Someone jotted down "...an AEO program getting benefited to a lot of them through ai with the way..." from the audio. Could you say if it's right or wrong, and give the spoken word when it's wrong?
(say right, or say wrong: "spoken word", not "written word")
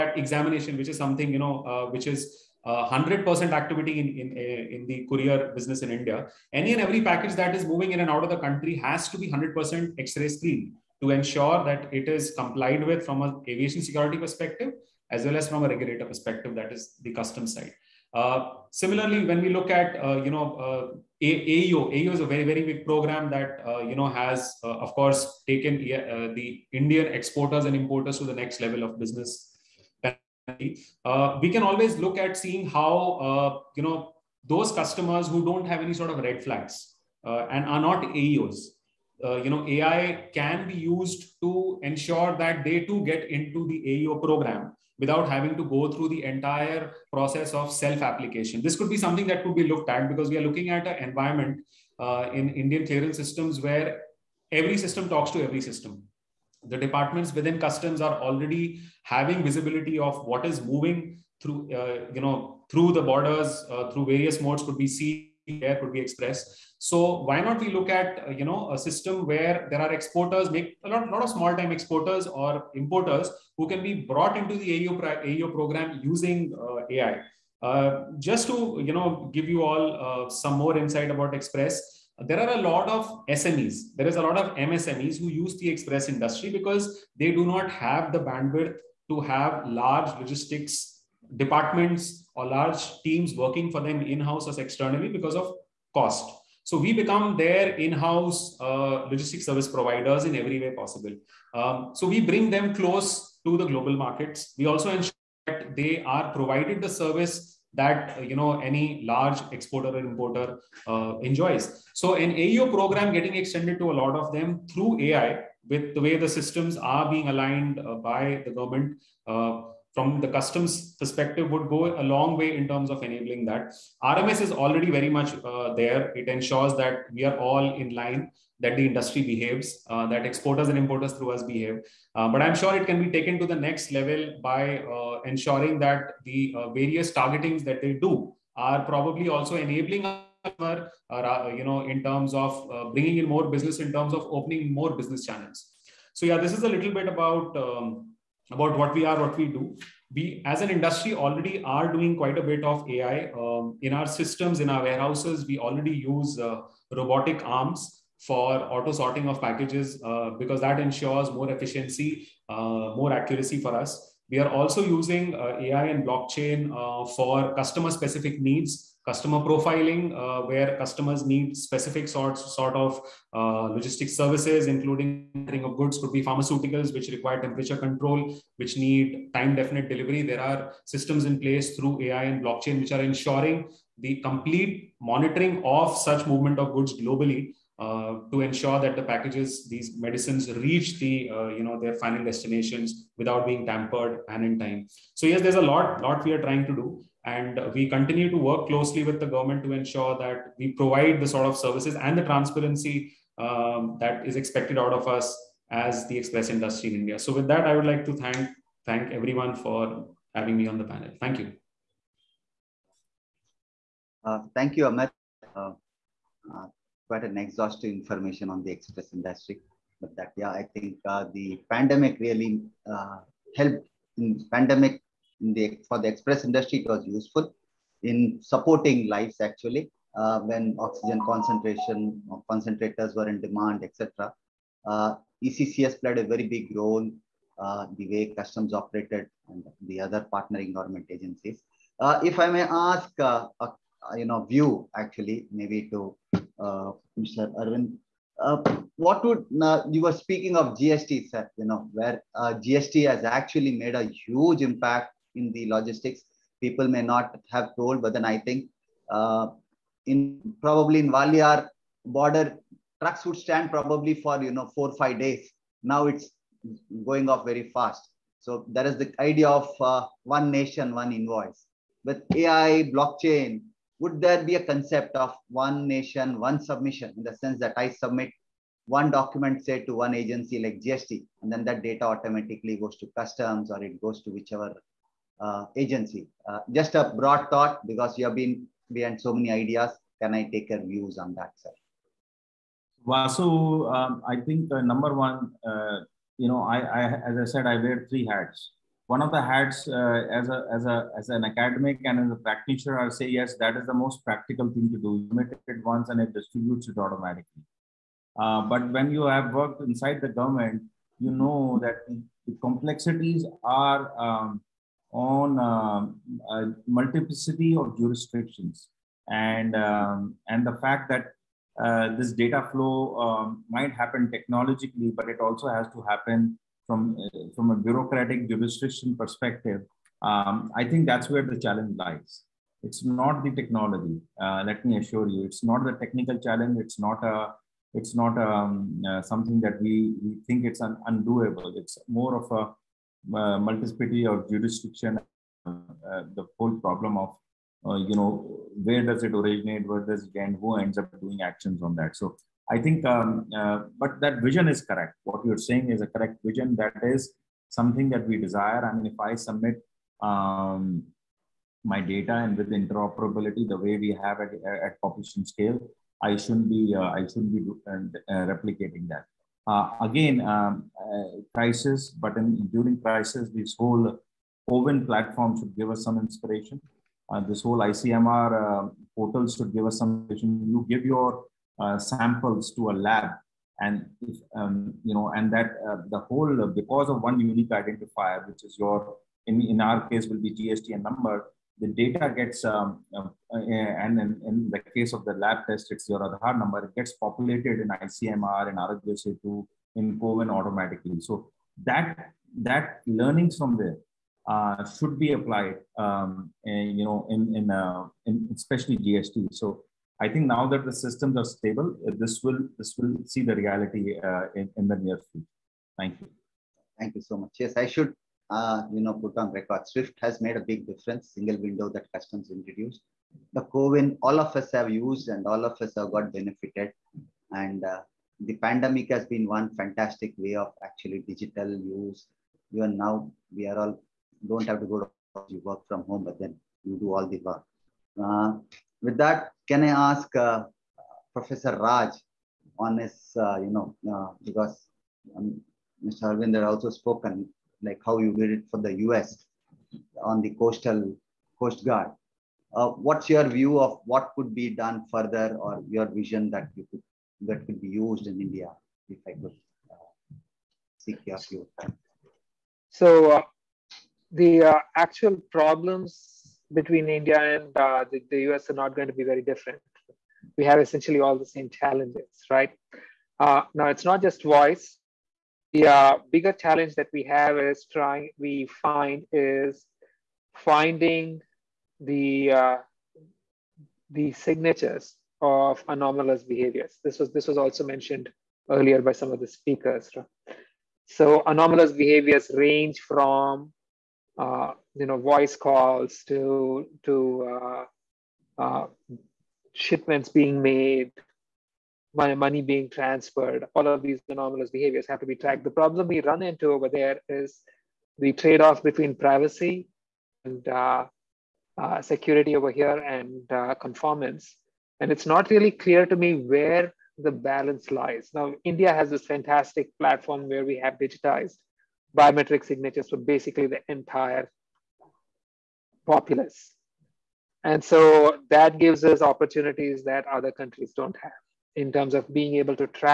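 wrong: "extended", not "benefited".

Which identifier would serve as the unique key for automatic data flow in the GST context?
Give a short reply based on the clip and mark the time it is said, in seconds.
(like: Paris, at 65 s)
GSTN number, at 390 s.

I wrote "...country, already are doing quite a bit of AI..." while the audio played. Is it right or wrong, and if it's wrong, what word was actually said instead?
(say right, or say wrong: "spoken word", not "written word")
wrong: "industry", not "country".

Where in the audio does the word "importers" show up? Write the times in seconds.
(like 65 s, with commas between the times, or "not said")
27 s, 72 s, 109 s, 130 s.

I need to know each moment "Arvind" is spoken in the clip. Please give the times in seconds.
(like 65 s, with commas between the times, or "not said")
247 s, 446 s.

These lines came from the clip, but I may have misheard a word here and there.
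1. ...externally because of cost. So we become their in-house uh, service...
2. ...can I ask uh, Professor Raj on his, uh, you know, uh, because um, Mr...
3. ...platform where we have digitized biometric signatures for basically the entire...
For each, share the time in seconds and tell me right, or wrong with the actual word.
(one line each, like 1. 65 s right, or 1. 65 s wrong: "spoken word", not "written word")
1. 94 s right
2. 439 s right
3. 519 s right.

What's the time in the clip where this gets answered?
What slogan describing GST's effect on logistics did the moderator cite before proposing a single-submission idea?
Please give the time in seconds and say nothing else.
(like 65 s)
270 s.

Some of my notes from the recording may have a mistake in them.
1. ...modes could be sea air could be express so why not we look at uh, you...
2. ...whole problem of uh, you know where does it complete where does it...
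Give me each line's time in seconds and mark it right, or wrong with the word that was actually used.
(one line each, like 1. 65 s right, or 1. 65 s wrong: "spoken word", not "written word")
1. 64 s right
2. 346 s wrong: "originate", not "complete".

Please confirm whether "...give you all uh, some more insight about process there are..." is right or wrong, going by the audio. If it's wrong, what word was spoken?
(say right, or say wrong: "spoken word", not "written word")
wrong: "express", not "process".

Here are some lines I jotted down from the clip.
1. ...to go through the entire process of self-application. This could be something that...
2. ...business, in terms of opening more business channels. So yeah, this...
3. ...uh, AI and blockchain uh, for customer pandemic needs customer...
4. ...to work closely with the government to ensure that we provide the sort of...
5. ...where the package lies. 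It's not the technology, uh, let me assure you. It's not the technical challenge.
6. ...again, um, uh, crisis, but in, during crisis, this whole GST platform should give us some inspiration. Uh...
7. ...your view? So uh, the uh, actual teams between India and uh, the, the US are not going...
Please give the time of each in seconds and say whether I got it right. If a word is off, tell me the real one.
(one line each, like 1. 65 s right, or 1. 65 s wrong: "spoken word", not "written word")
1. 45 s right
2. 143 s right
3. 165 s wrong: "specific", not "pandemic"
4. 198 s right
5. 331 s wrong: "challenge", not "package"
6. 370 s wrong: "CoWIN", not "GST"
7. 461 s wrong: "problems", not "teams".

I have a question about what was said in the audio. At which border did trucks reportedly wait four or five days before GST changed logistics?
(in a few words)
Walayar.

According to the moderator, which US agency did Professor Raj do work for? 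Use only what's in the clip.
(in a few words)
coast guard.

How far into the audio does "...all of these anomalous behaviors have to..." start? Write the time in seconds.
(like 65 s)
503 s.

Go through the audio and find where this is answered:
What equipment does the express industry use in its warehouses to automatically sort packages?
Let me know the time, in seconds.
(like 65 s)
156 s.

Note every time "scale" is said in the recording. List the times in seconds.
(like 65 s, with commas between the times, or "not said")
365 s.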